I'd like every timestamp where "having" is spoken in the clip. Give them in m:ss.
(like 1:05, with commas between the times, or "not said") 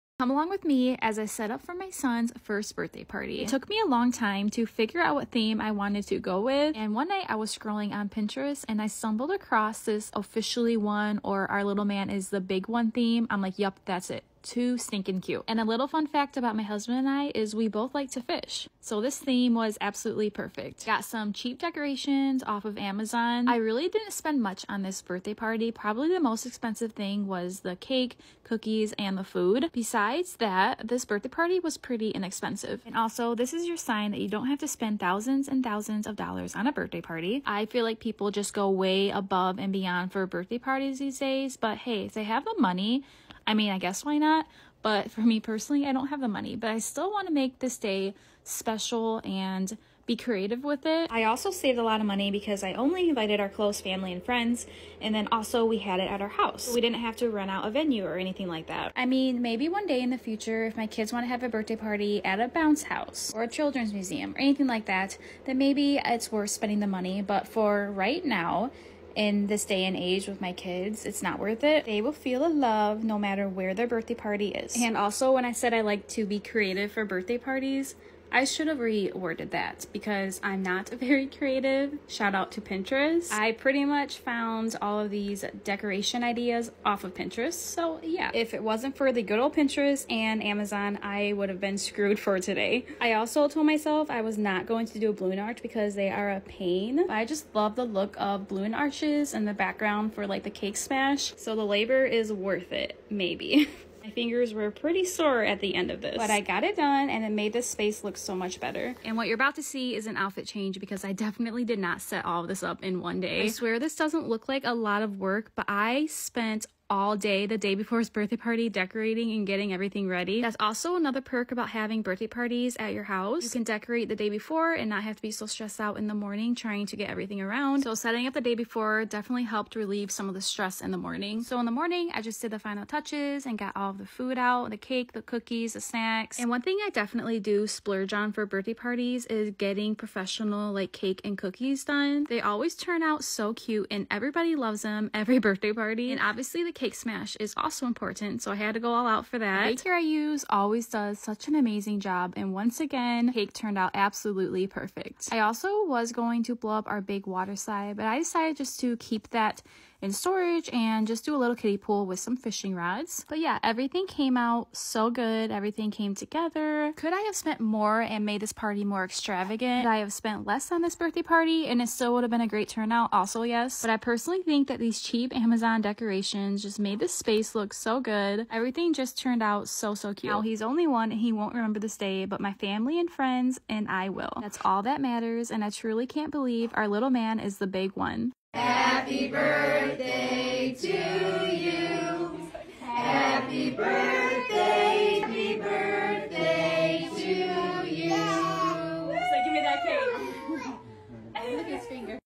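2:01.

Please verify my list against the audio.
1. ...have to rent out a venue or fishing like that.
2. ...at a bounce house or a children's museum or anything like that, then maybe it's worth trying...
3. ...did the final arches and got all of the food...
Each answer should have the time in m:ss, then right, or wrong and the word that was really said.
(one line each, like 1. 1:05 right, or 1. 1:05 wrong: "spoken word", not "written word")
1. 0:57 wrong: "anything", not "fishing"
2. 1:02 wrong: "spending", not "trying"
3. 2:12 wrong: "touches", not "arches".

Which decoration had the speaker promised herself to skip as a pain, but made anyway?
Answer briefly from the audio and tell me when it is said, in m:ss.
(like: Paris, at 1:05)
Balloon arch, at 1:35.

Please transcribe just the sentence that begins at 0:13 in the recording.
I'm like, yep, that's it too stinking cute.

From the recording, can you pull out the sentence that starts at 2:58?
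Everything just turned out so, so cute.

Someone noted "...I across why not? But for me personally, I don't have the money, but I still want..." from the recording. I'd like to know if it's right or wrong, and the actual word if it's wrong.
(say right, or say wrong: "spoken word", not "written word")
wrong: "guess", not "across".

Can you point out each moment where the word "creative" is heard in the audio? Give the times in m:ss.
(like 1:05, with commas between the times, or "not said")
0:50, 1:16, 1:21.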